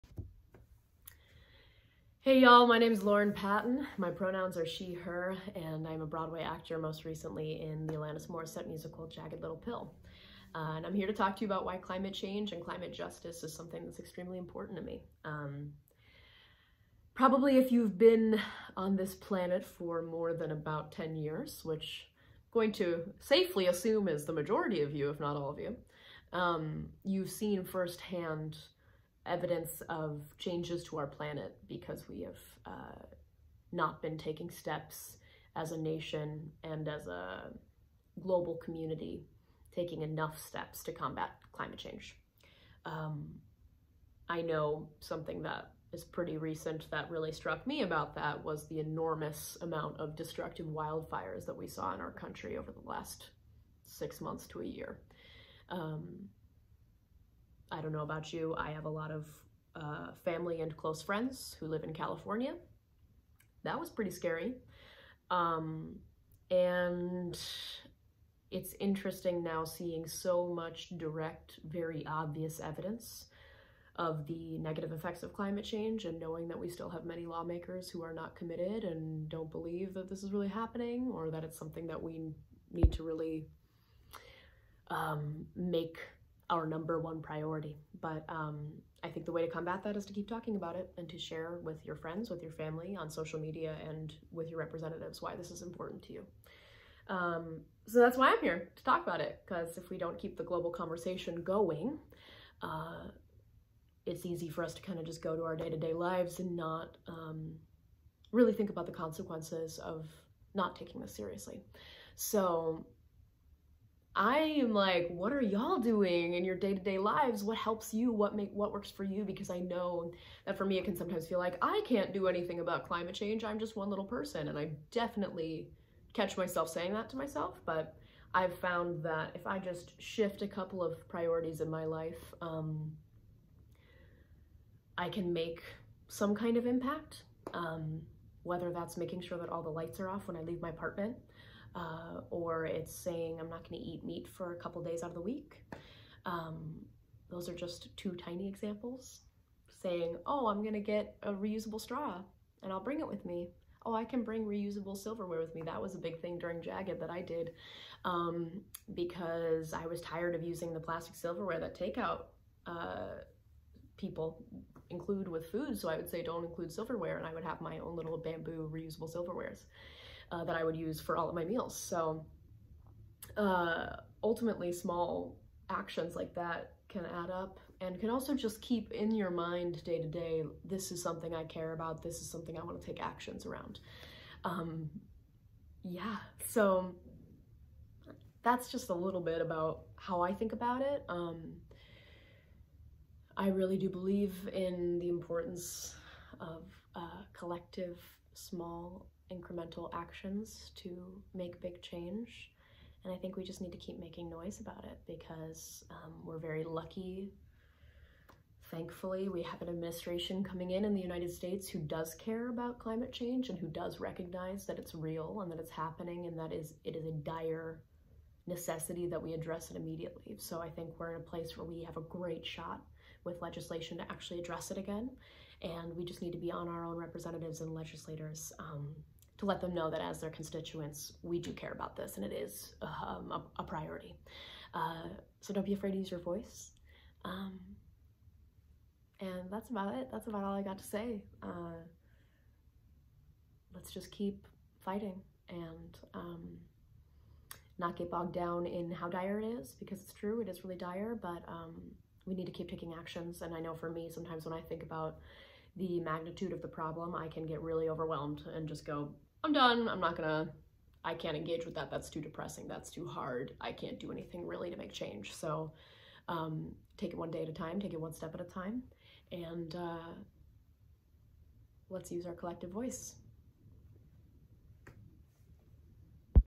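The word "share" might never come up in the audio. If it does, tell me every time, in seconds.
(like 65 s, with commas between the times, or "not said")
91 s.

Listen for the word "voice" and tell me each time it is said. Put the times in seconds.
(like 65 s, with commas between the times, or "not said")
236 s, 272 s.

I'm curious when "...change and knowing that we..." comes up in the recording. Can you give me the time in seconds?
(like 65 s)
75 s.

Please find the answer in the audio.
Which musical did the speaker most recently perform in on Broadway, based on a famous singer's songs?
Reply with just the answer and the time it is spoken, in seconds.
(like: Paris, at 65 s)
Jagged Little Pill, at 9 s.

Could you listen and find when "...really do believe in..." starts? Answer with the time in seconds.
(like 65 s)
193 s.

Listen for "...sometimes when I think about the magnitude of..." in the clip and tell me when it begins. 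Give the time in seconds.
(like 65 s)
254 s.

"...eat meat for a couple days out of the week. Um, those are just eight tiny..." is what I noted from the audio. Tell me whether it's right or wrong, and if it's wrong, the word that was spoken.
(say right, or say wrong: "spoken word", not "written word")
wrong: "two", not "eight".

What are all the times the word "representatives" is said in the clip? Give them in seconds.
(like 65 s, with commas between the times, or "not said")
94 s, 226 s.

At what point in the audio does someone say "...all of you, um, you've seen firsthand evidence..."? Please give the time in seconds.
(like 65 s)
25 s.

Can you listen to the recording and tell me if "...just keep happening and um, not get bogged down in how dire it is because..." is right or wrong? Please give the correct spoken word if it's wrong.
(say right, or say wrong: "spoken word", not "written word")
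wrong: "fighting", not "happening".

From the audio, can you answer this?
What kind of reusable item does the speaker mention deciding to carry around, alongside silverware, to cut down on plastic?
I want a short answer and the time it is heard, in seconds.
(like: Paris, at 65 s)
Straw, at 151 s.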